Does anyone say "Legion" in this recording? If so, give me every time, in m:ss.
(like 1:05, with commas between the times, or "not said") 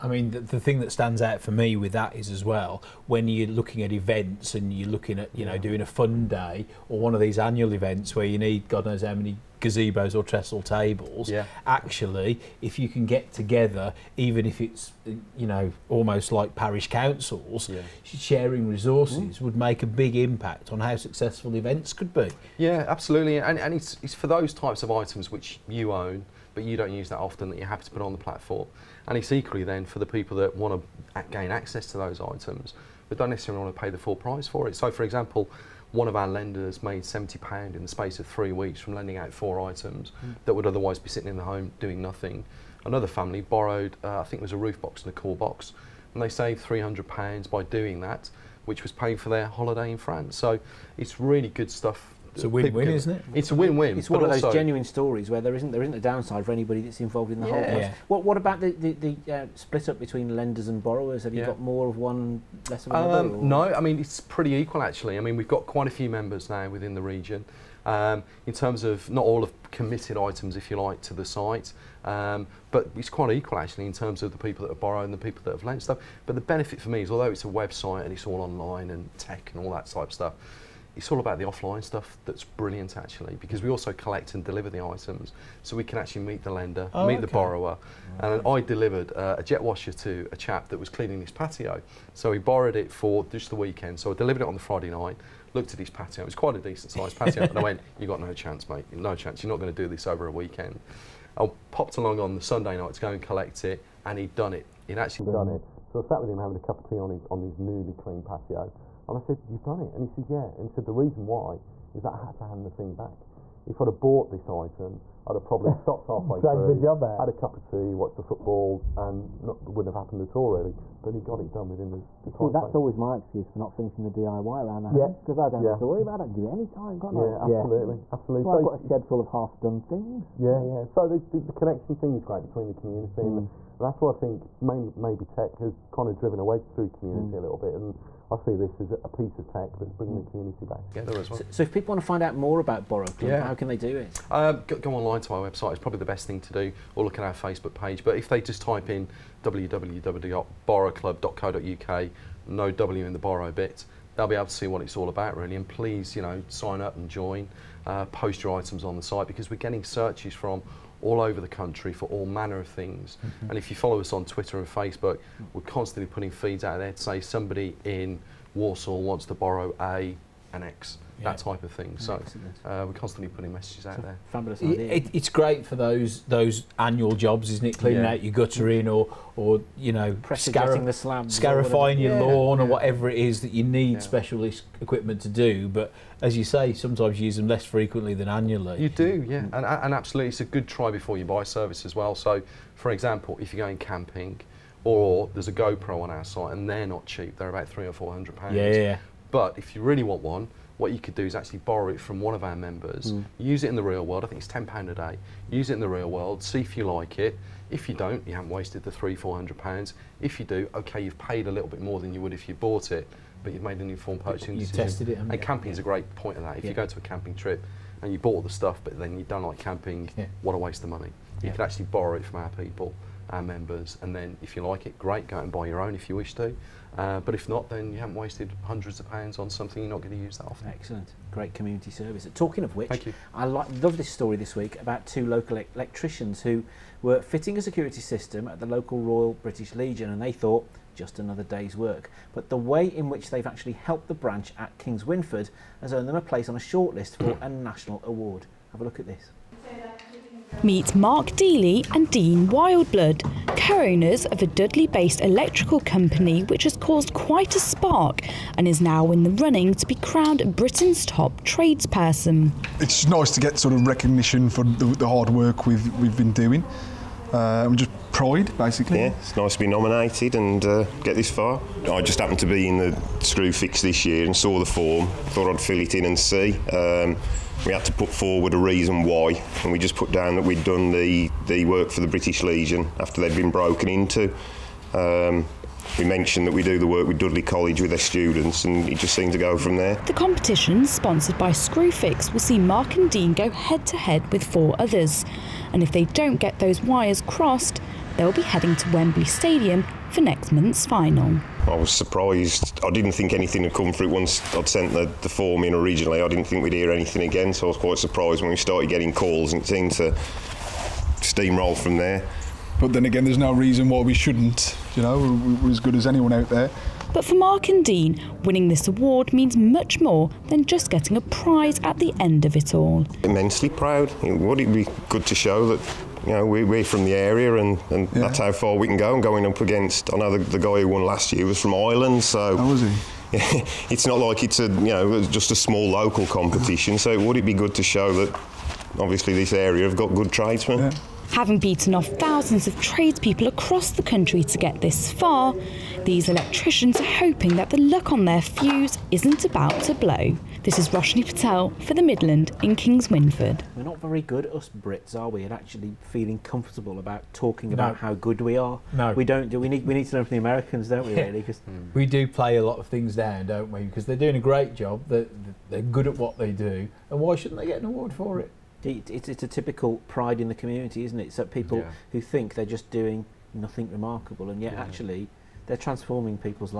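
3:59, 4:42.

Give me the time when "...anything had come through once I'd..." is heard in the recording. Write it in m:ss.
5:03.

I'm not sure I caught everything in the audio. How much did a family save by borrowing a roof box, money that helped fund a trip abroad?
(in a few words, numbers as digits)
£300.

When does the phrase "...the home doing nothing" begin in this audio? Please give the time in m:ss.
0:41.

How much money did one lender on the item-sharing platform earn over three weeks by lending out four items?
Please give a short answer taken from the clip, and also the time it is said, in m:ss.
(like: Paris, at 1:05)
£70, at 0:37.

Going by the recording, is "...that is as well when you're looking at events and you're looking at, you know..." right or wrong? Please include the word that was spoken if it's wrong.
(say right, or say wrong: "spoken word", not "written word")
right.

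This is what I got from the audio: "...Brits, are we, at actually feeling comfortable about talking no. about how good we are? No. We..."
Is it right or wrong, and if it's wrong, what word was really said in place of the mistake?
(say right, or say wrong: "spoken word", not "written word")
right.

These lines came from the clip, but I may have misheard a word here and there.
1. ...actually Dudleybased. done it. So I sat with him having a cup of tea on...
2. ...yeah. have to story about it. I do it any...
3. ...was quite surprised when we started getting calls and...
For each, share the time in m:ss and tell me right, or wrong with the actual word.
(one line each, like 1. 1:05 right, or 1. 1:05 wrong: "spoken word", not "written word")
1. 1:44 wrong: "Brilliant", not "Dudleybased"
2. 2:05 wrong: "worry", not "story"
3. 5:07 right.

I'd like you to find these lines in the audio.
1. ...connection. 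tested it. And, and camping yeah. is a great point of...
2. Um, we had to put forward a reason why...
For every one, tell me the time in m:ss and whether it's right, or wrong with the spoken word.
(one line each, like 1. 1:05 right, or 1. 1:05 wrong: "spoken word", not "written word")
1. 3:34 wrong: "decision", not "connection"
2. 4:36 right.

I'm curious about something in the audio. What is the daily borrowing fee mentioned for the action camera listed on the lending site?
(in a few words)
£10.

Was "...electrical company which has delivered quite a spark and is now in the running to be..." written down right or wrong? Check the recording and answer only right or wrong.
wrong.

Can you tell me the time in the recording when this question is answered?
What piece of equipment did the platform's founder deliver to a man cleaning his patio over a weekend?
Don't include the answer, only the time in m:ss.
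1:29.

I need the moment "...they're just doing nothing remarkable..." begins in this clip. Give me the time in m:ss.
6:12.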